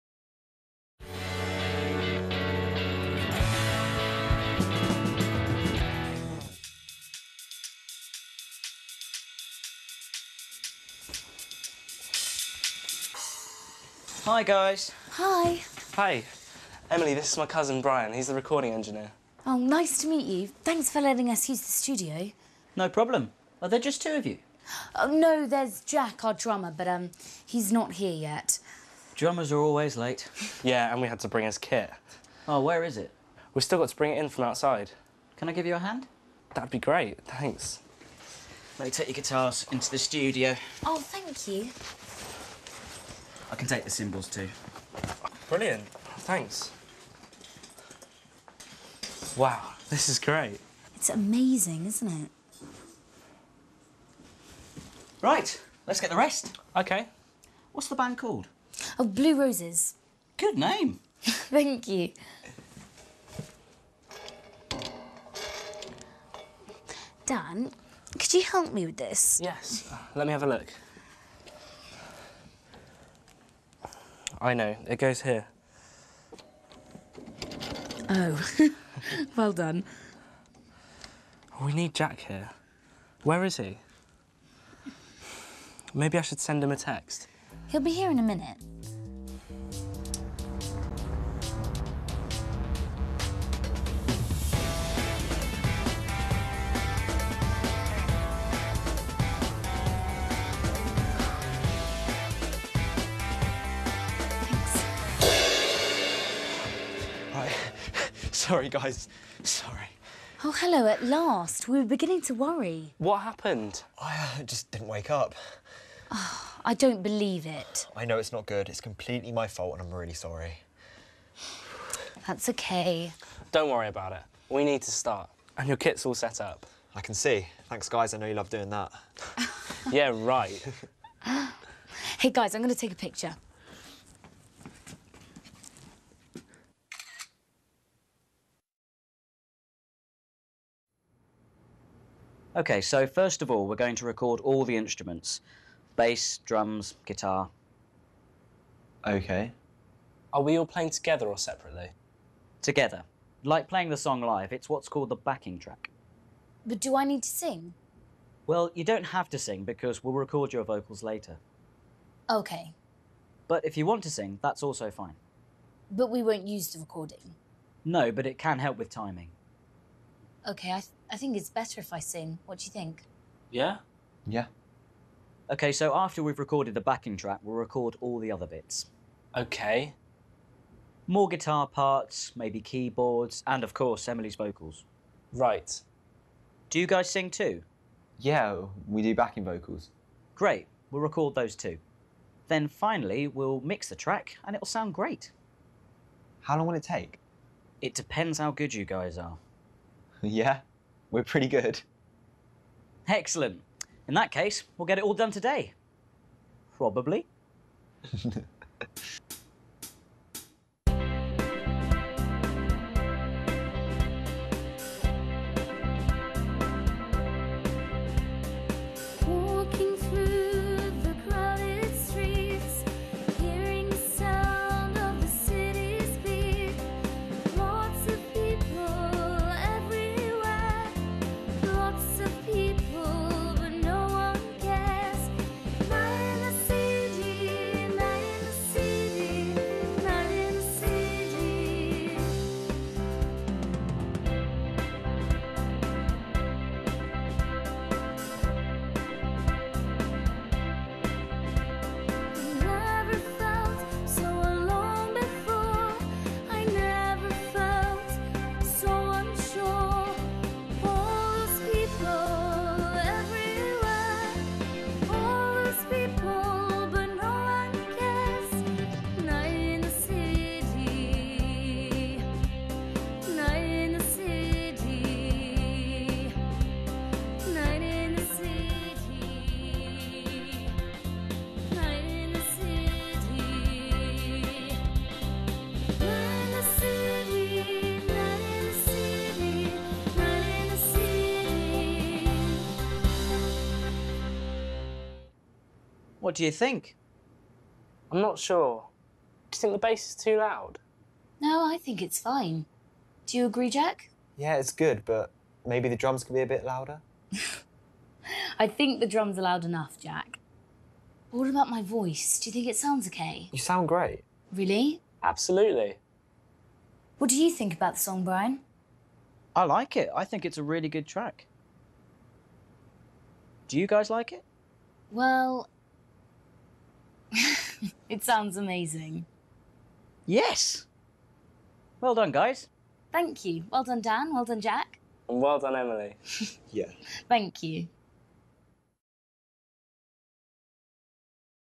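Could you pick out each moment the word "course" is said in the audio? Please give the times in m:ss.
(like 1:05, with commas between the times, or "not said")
3:03.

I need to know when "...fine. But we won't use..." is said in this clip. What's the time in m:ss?
2:44.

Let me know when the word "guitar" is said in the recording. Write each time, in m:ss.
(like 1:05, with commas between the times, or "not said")
0:39, 2:27, 3:01.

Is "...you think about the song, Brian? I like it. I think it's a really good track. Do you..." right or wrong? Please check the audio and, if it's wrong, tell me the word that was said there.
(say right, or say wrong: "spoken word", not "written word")
right.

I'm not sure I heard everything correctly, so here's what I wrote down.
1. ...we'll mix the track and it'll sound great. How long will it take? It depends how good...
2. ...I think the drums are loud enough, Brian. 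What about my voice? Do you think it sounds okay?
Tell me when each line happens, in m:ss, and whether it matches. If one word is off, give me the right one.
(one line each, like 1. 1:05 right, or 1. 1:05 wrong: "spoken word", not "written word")
1. 3:13 right
2. 5:08 wrong: "Jack", not "Brian".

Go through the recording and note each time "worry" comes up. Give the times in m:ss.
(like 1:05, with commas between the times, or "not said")
1:52, 2:03.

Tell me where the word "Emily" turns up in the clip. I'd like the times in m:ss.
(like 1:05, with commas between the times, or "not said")
0:16, 3:04, 5:35.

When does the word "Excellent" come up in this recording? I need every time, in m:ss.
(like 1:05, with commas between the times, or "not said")
3:23.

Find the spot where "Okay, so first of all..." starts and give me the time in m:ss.
2:22.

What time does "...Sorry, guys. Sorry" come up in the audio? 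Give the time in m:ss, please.
1:48.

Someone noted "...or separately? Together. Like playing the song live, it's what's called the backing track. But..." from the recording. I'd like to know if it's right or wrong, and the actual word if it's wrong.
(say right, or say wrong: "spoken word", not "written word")
right.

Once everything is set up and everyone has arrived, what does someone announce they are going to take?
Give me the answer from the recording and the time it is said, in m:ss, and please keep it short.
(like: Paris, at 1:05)
a picture, at 2:12.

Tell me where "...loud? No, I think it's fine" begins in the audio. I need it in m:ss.
5:00.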